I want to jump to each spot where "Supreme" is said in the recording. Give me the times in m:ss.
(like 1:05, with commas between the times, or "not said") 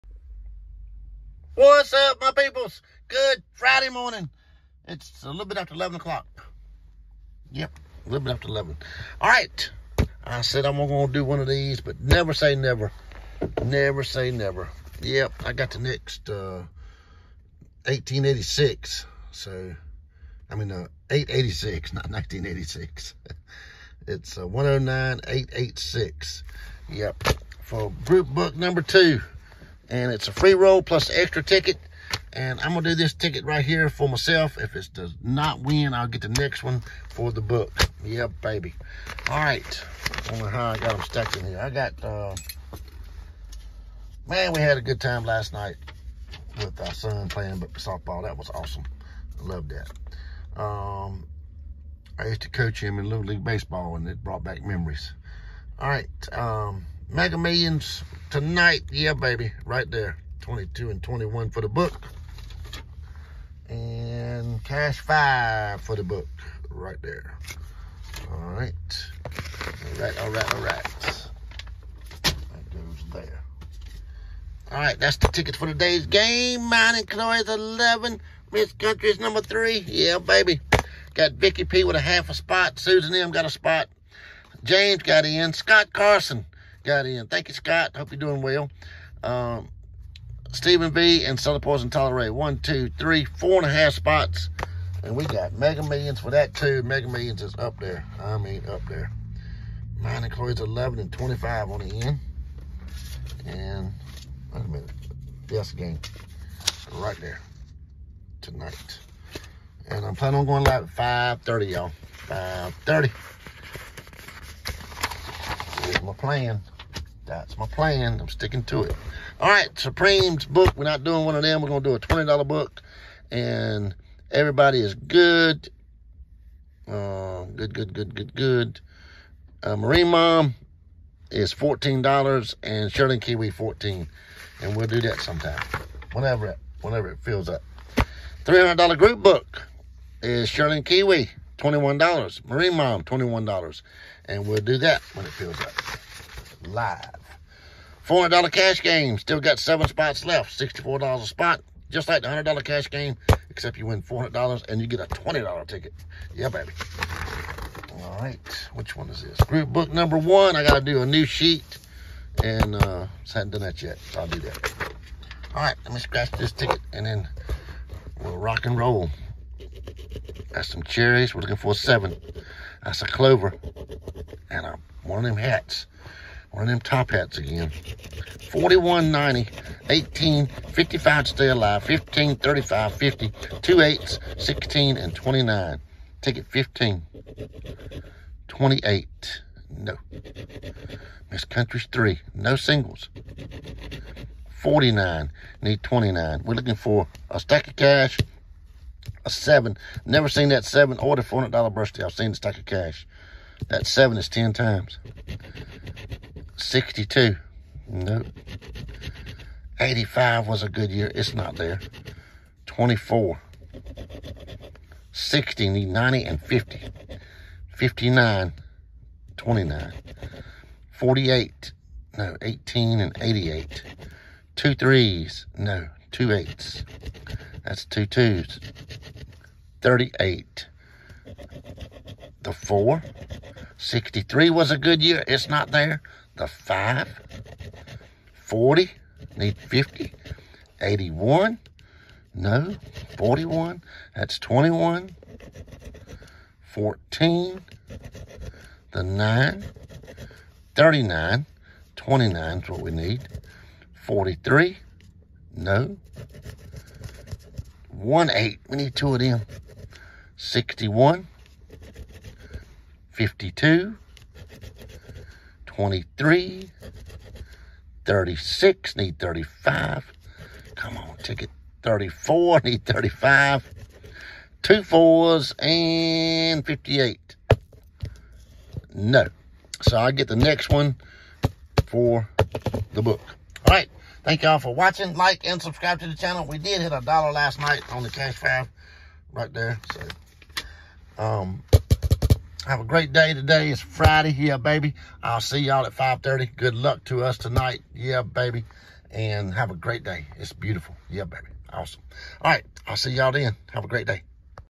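1:59.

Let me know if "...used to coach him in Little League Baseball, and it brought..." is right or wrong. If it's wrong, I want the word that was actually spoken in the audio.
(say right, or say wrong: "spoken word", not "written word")
right.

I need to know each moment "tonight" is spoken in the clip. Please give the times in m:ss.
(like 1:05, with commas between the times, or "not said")
0:58, 1:48, 4:57.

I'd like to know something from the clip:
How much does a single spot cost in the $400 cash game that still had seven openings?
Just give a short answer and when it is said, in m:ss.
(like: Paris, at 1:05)
$64, at 2:30.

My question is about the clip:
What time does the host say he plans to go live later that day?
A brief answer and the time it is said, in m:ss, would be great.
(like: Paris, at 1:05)
5:30, at 1:52.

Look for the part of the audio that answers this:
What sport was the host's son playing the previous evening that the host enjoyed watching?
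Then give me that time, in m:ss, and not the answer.
0:47.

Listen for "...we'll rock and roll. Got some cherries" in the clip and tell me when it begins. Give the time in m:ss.
2:48.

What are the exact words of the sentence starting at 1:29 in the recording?
Um, Stephen B and Southern Poison Tolerate.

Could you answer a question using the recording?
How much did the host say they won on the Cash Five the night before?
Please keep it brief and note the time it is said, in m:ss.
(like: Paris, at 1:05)
A dollar, at 4:46.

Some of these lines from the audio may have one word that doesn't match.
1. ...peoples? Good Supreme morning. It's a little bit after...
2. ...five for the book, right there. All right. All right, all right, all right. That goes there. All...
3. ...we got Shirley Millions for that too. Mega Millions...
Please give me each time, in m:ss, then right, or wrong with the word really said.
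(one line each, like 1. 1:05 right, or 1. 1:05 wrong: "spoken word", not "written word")
1. 0:02 wrong: "Friday", not "Supreme"
2. 1:05 right
3. 1:35 wrong: "Mega", not "Shirley".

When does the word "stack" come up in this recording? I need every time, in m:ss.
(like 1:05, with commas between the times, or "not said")
3:17, 3:22.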